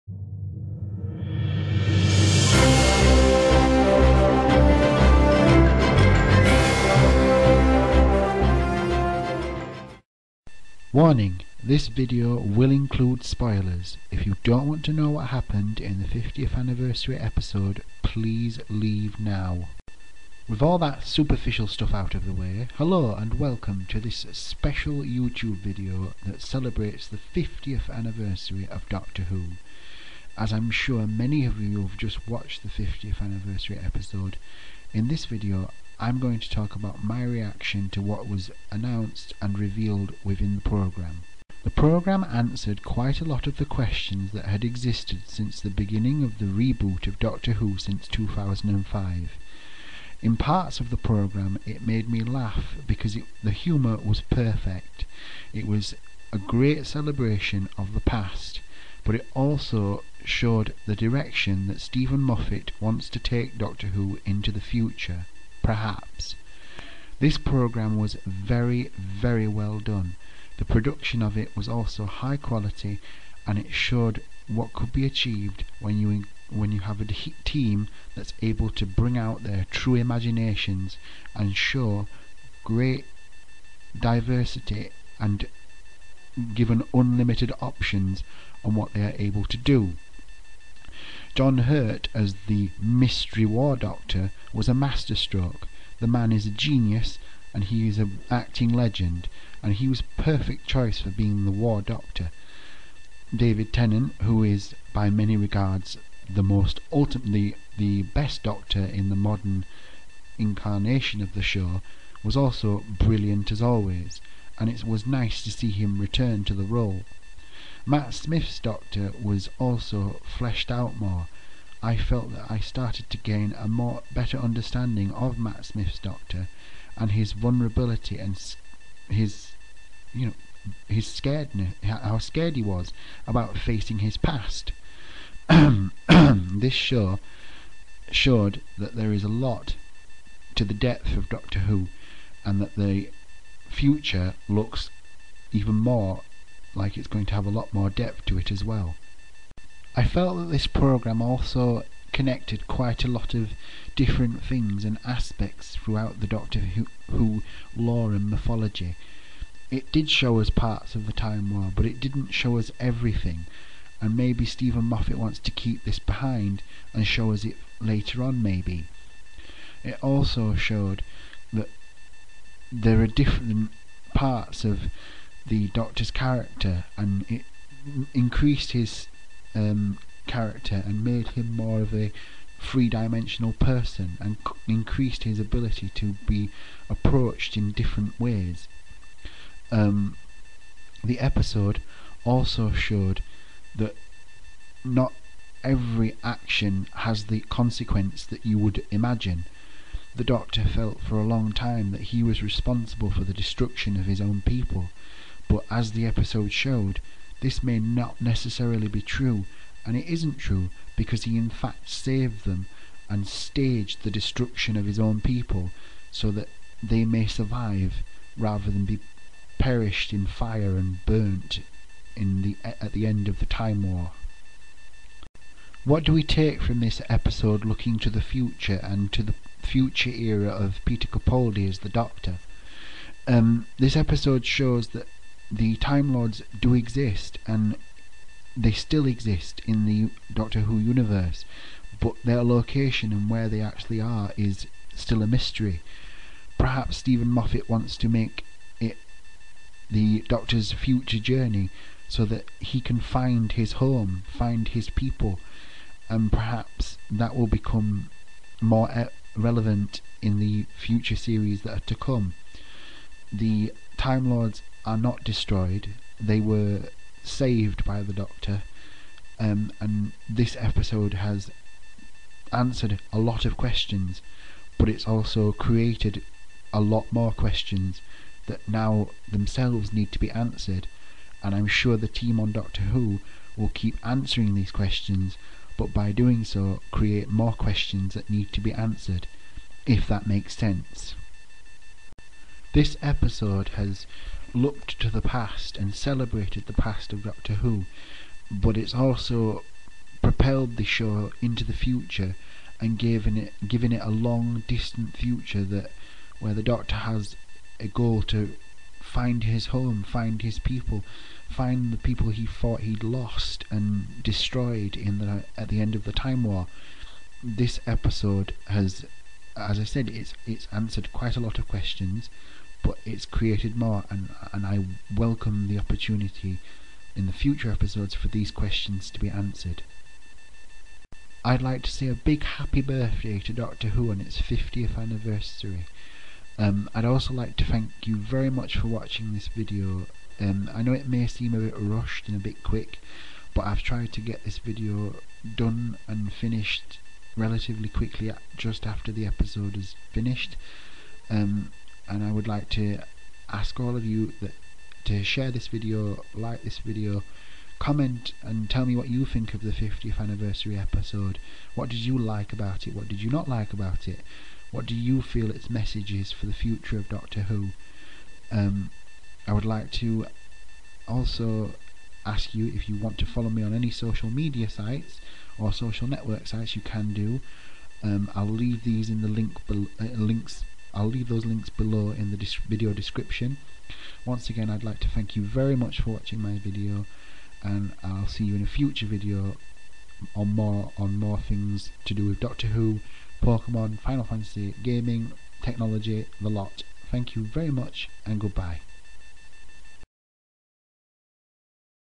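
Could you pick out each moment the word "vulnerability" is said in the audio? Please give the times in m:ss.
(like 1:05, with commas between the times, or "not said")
2:07.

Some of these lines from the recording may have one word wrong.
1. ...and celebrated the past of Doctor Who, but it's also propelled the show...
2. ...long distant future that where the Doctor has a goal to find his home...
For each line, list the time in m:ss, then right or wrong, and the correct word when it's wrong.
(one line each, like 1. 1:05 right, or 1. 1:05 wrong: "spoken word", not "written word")
1. 4:55 right
2. 5:04 right.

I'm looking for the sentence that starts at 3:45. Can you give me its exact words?
What do we take from this episode looking to the future and to the future era of Peter Capaldi as the Doctor?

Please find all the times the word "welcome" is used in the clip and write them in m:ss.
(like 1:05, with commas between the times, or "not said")
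0:23, 5:25.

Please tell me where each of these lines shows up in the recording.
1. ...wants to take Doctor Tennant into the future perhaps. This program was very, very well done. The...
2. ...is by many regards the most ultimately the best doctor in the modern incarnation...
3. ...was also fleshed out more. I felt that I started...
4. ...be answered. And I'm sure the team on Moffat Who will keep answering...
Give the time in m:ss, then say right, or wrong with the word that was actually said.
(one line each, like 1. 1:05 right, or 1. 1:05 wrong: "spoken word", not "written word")
1. 1:02 wrong: "Who", not "Tennant"
2. 1:44 right
3. 1:59 right
4. 4:40 wrong: "Doctor", not "Moffat".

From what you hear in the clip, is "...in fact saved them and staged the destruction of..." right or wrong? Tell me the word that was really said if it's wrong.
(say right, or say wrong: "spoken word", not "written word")
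right.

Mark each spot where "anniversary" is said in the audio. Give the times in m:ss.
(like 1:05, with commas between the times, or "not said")
0:16, 0:27, 0:33, 5:34, 6:00.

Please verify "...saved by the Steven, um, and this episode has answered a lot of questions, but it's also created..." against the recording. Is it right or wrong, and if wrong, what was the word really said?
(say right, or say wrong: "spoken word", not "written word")
wrong: "Doctor", not "Steven".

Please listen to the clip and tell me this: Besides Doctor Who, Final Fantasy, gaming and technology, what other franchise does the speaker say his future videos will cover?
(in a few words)
Pokemon.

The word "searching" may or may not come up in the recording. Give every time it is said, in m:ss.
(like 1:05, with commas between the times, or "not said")
not said.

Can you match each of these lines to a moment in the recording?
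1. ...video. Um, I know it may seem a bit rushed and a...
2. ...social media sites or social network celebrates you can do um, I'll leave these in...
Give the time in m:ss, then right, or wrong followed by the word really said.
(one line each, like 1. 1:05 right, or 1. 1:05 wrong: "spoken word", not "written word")
1. 5:39 right
2. 6:13 wrong: "sites", not "celebrates".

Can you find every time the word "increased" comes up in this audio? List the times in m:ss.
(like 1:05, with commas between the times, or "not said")
2:58, 3:04.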